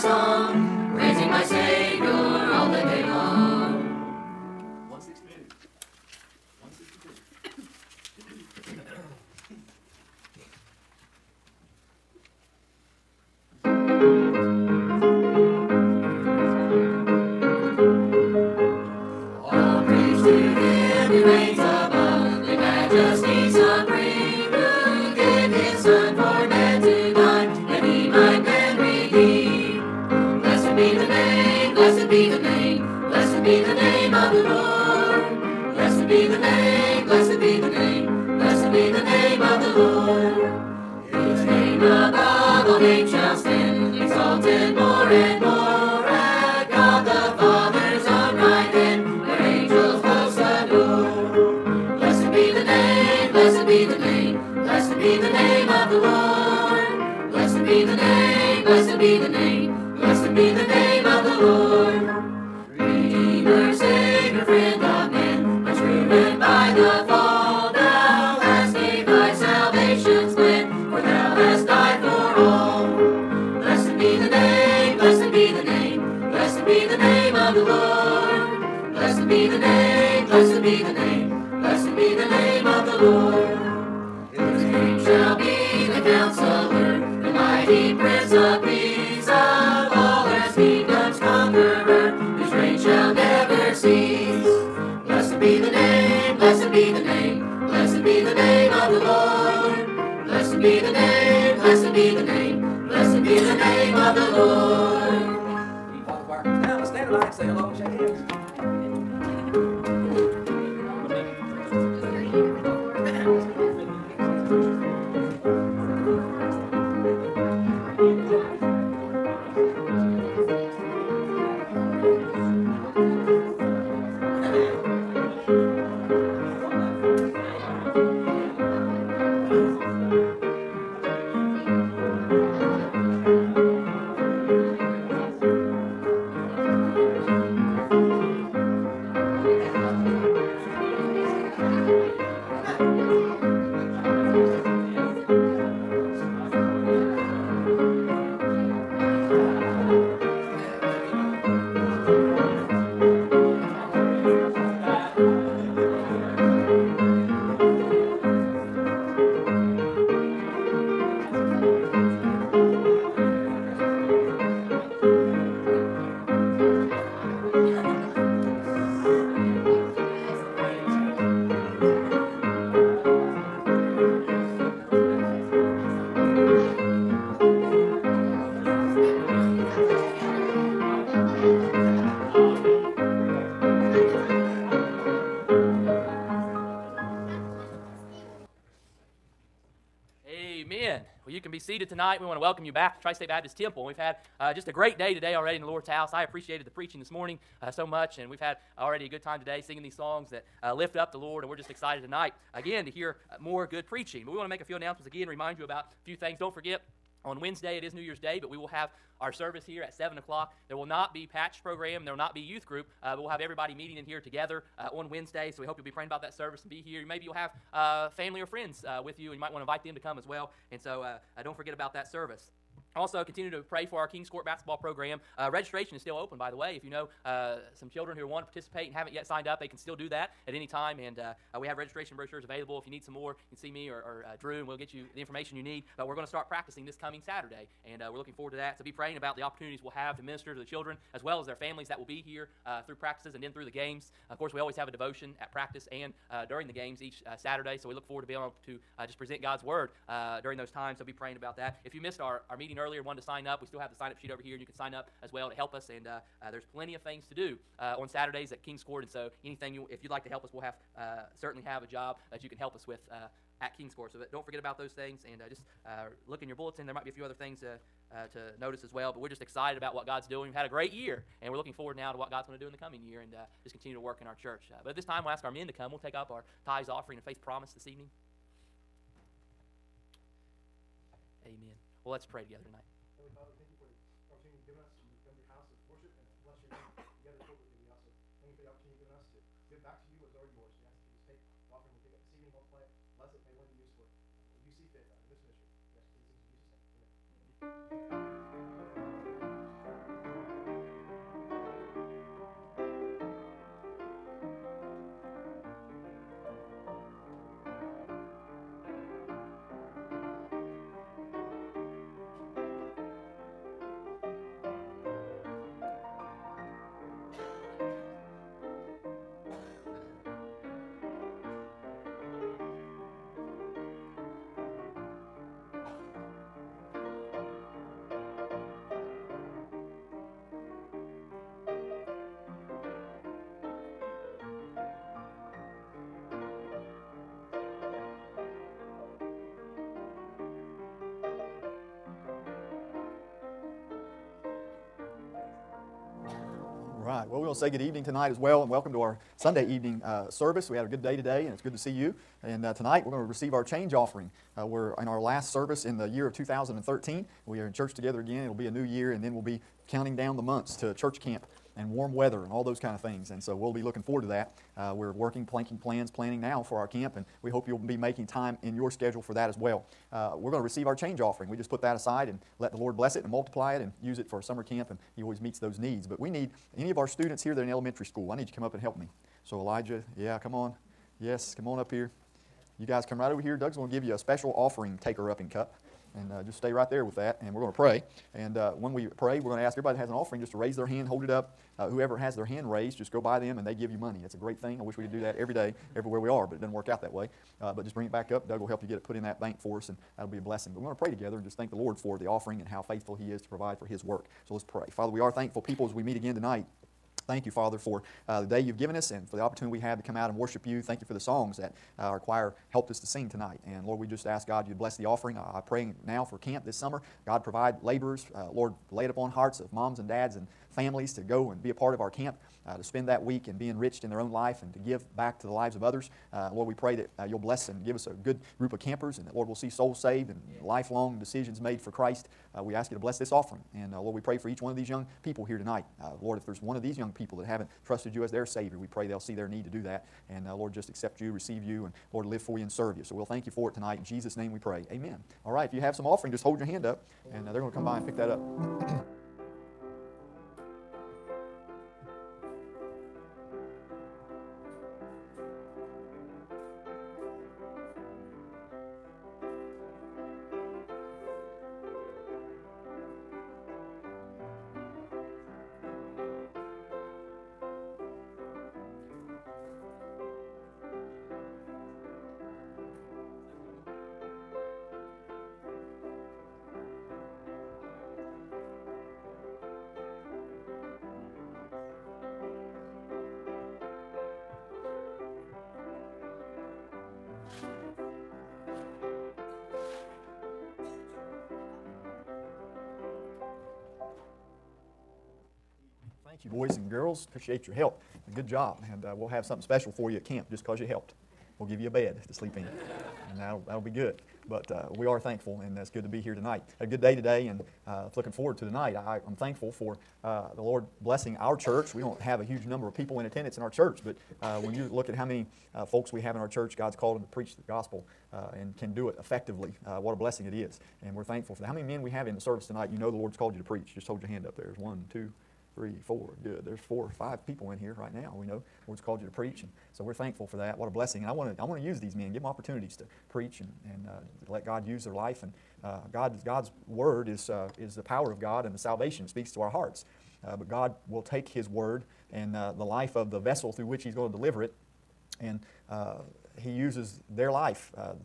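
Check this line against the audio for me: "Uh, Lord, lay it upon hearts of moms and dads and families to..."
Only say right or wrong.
right.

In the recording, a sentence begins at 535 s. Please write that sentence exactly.
And uh, God, God's Word is, uh, is the power of God and the salvation.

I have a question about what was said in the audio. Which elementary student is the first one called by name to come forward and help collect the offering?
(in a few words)
Elijah.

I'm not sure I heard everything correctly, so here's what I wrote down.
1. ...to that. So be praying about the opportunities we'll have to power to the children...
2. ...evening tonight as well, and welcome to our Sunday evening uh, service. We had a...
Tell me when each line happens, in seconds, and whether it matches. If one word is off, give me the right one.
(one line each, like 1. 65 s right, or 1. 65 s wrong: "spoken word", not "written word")
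1. 238 s wrong: "minister", not "power"
2. 347 s right.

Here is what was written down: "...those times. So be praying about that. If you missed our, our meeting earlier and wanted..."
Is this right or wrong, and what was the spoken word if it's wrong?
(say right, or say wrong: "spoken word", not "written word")
right.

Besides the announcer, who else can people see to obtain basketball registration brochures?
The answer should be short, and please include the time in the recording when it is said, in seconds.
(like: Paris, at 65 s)
Drew, at 234 s.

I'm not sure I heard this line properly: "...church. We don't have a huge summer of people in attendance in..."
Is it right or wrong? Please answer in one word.
wrong.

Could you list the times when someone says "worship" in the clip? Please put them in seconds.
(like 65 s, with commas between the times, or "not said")
410 s.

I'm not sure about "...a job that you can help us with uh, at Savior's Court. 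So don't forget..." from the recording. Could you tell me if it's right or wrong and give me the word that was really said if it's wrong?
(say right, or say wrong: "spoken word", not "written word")
wrong: "King", not "Savior".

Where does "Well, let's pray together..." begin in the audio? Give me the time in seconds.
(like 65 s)
282 s.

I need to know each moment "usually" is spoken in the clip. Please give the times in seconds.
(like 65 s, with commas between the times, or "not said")
not said.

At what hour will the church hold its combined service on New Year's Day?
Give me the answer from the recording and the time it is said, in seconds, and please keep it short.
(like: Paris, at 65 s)
7 o'clock, at 209 s.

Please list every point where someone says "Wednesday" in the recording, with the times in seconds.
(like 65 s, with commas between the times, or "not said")
207 s, 215 s.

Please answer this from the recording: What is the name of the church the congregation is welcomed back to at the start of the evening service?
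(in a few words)
Tri State Baptist Temple.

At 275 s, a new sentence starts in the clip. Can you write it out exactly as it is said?
We'll take up our tithes offering and faith promise this evening.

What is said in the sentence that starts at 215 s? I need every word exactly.
So we hope you'll be praying about that service and be here.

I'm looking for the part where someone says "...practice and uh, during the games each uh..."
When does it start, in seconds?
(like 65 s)
245 s.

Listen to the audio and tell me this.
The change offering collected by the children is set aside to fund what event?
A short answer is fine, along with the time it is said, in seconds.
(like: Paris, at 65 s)
summer camp, at 374 s.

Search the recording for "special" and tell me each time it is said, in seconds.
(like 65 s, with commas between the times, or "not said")
384 s, 499 s.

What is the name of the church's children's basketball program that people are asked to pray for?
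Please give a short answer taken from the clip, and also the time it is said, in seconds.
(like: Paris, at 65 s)
Kings Court, at 224 s.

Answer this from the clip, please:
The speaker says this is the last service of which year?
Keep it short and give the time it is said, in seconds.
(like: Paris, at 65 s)
2013, at 356 s.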